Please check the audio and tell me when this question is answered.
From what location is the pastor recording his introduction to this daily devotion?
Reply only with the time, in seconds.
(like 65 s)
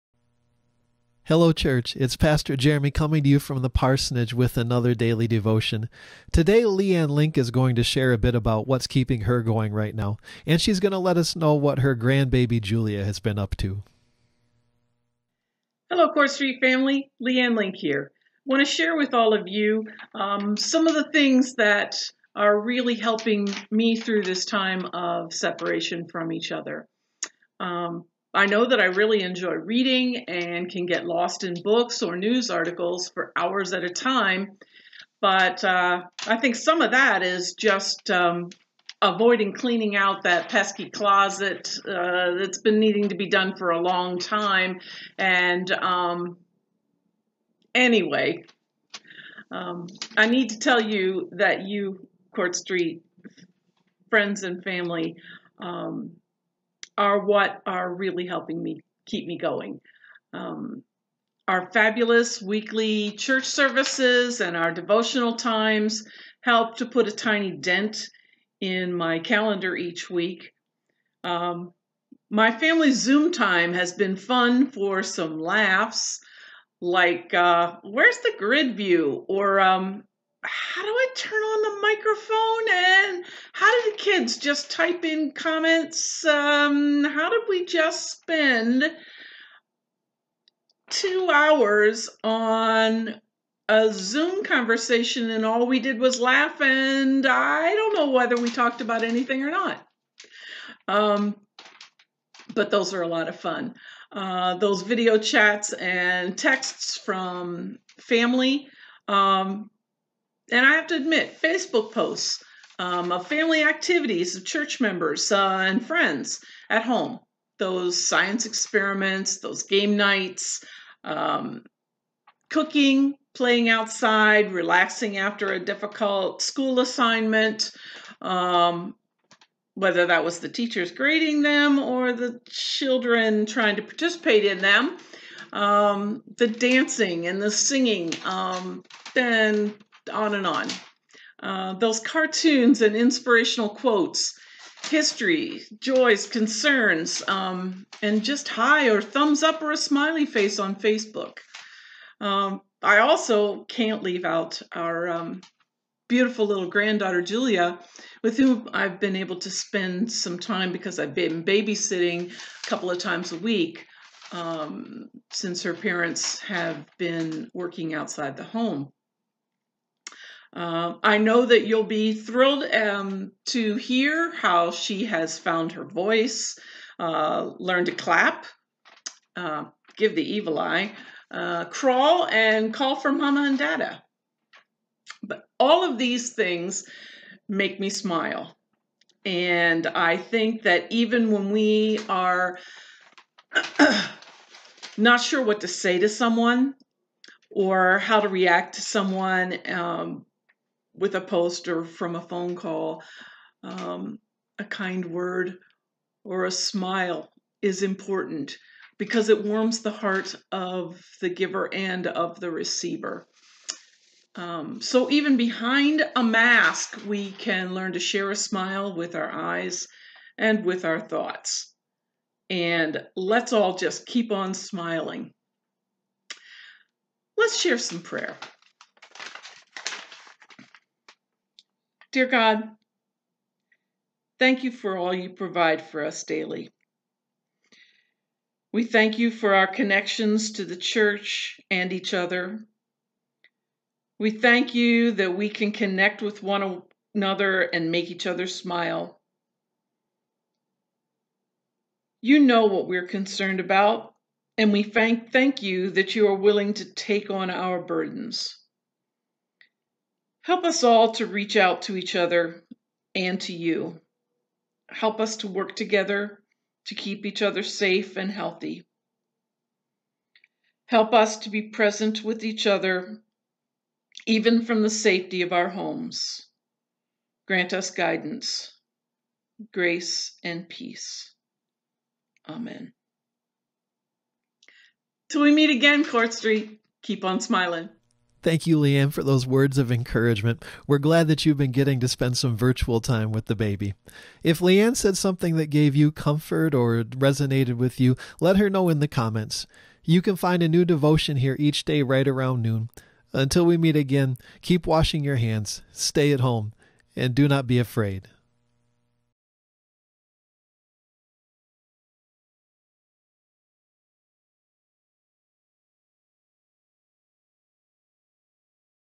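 3 s.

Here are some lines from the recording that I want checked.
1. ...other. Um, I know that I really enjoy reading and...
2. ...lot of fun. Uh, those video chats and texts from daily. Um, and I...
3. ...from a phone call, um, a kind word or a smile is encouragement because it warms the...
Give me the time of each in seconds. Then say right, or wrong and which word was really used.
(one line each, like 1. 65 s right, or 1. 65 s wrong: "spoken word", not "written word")
1. 26 s right
2. 103 s wrong: "family", not "daily"
3. 201 s wrong: "important", not "encouragement".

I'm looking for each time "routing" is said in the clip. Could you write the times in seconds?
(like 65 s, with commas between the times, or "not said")
not said.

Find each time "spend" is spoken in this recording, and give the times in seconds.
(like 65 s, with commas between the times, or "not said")
88 s, 159 s, 292 s.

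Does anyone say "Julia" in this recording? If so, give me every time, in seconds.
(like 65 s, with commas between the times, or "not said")
12 s, 157 s.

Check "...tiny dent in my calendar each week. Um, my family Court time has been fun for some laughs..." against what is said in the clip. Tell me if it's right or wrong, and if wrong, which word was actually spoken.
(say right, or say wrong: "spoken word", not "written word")
wrong: "Zoom", not "Court".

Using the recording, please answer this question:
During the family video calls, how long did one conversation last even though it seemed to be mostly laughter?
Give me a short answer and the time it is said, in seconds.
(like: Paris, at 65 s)
2 hours, at 90 s.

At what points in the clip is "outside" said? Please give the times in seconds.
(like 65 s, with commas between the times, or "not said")
123 s, 167 s.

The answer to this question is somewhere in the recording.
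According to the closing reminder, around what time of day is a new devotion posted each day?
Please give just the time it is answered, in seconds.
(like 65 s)
302 s.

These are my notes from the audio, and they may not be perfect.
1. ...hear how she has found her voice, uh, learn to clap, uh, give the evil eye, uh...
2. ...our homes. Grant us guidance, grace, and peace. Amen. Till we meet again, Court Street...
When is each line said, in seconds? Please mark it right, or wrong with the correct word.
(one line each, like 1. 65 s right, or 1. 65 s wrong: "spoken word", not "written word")
1. 173 s right
2. 275 s right.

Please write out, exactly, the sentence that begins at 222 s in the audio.
And let's all just keep on smiling.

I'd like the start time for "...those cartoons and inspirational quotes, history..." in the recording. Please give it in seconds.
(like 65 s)
141 s.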